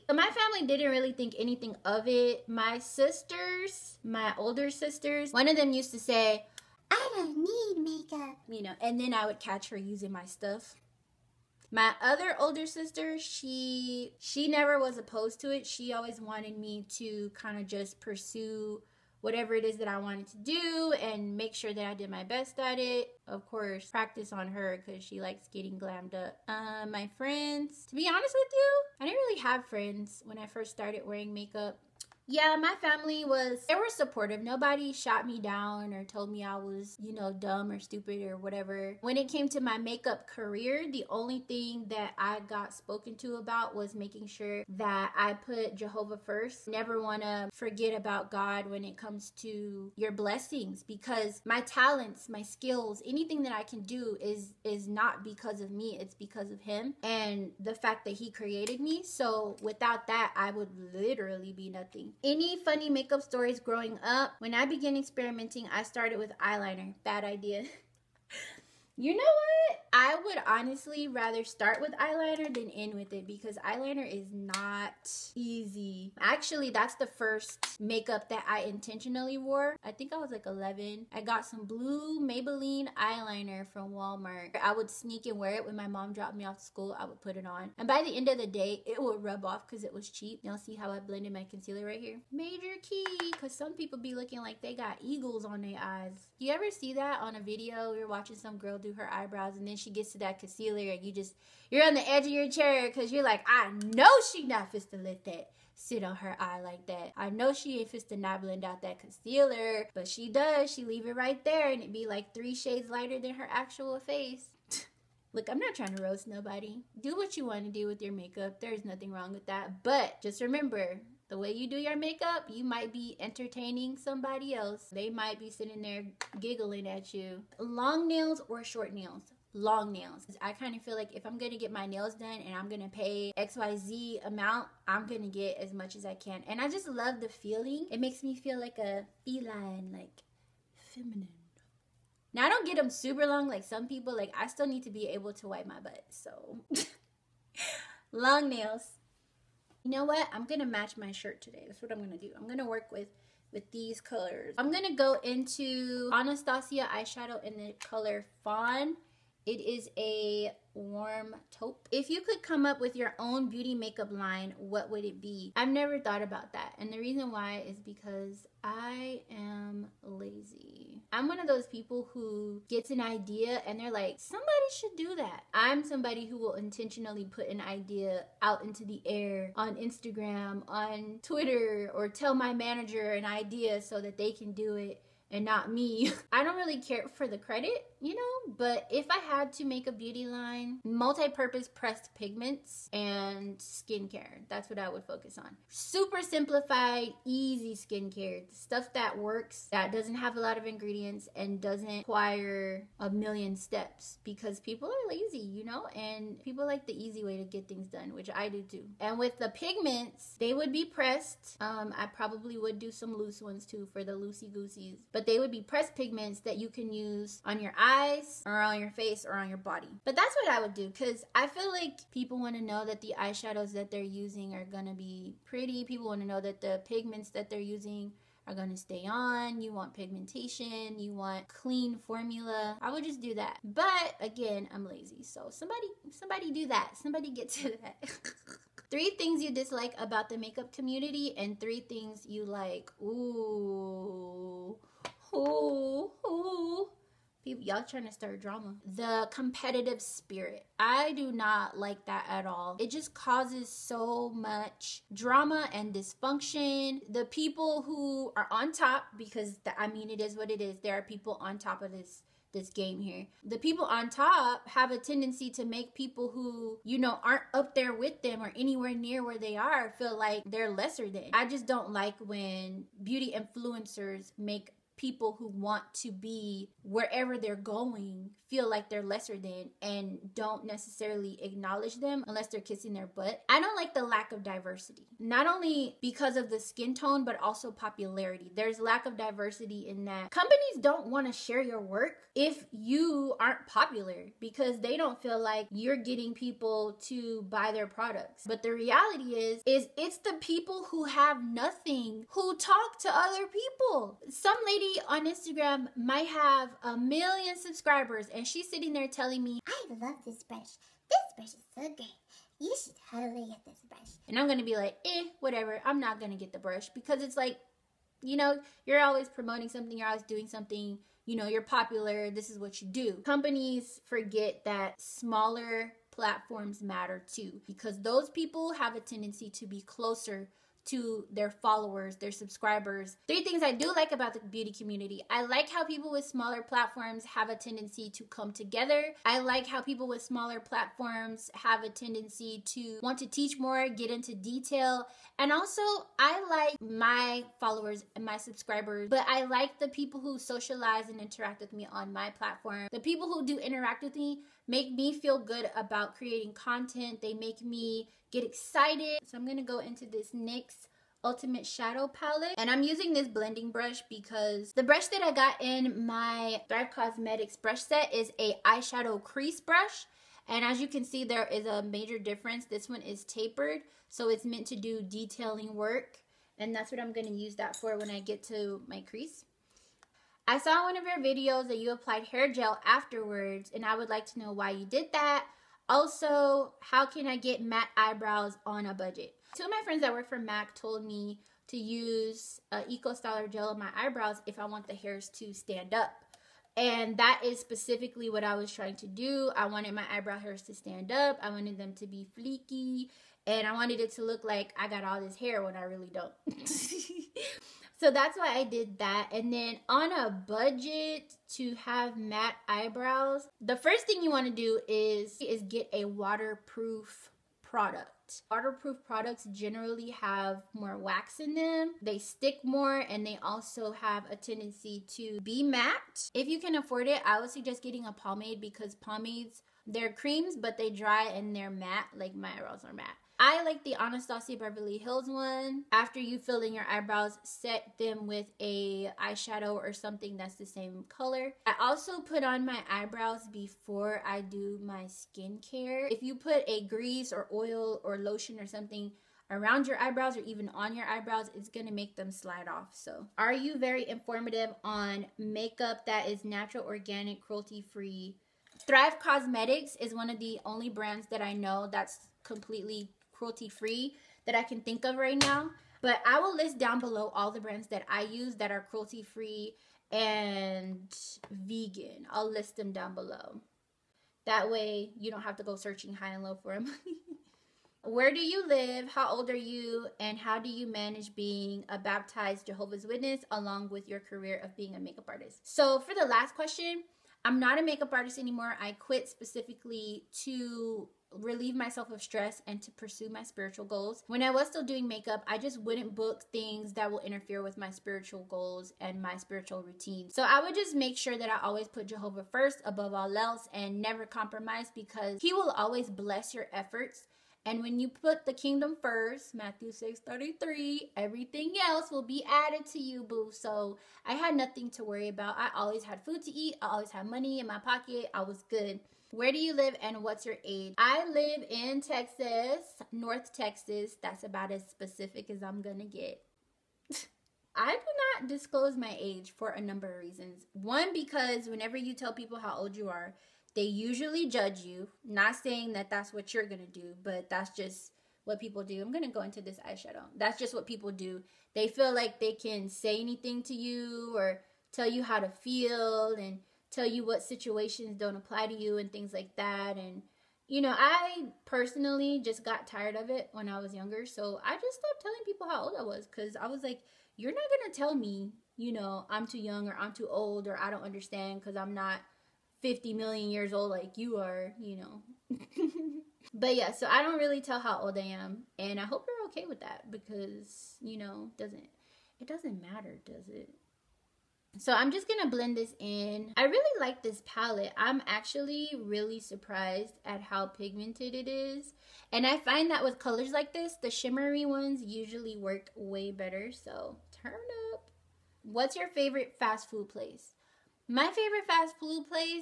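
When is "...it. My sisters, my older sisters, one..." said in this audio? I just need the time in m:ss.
0:02.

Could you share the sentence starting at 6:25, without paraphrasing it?
Also, how can I get matte eyebrows on a budget?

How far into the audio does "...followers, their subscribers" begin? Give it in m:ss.
5:31.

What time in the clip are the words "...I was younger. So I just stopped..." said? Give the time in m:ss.
9:13.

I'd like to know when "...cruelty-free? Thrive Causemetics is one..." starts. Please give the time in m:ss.
7:37.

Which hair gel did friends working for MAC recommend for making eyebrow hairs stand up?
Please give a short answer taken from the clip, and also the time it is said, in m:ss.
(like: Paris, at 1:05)
Eco Styler, at 6:32.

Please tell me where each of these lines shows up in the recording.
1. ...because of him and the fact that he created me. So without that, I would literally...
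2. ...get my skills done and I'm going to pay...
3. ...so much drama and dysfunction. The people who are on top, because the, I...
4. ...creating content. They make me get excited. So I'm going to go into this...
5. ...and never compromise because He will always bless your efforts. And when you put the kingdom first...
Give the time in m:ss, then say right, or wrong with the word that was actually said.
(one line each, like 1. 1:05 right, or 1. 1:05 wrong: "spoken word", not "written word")
1. 0:56 right
2. 2:11 wrong: "nails", not "skills"
3. 4:13 right
4. 5:56 right
5. 8:23 right.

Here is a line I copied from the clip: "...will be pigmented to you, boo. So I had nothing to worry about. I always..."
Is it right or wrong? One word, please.
wrong.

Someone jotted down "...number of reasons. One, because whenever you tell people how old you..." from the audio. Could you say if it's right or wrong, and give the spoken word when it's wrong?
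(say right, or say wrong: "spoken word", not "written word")
right.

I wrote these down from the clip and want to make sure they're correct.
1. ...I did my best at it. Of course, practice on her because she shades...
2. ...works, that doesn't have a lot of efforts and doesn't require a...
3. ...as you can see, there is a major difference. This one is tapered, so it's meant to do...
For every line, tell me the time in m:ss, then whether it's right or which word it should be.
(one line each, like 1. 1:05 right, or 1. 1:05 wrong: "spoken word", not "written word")
1. 0:21 wrong: "likes", not "shades"
2. 3:19 wrong: "ingredients", not "efforts"
3. 6:10 right.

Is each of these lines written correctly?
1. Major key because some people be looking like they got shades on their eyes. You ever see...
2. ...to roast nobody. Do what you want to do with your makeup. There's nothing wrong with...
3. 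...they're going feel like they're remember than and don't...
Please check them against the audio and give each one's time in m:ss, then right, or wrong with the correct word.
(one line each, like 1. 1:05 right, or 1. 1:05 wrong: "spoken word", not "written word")
1. 1:32 wrong: "eagles", not "shades"
2. 1:55 right
3. 4:37 wrong: "lesser", not "remember".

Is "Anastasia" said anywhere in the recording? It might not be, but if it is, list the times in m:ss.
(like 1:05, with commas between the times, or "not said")
2:36, 7:14.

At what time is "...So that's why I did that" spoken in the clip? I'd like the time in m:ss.
6:47.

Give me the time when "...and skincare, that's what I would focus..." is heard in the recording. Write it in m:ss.
3:12.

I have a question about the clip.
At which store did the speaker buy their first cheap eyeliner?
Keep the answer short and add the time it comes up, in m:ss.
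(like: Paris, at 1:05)
Walmart, at 1:23.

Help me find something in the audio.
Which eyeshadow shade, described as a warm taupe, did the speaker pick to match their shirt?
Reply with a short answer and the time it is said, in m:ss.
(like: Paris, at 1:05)
Fawn, at 2:38.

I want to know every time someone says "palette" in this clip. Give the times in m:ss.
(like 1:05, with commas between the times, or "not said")
6:02, 9:37.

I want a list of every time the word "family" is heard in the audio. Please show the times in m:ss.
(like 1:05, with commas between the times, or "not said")
0:00, 0:32.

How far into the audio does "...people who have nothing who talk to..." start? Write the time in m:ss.
5:00.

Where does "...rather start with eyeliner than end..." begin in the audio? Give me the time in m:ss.
1:11.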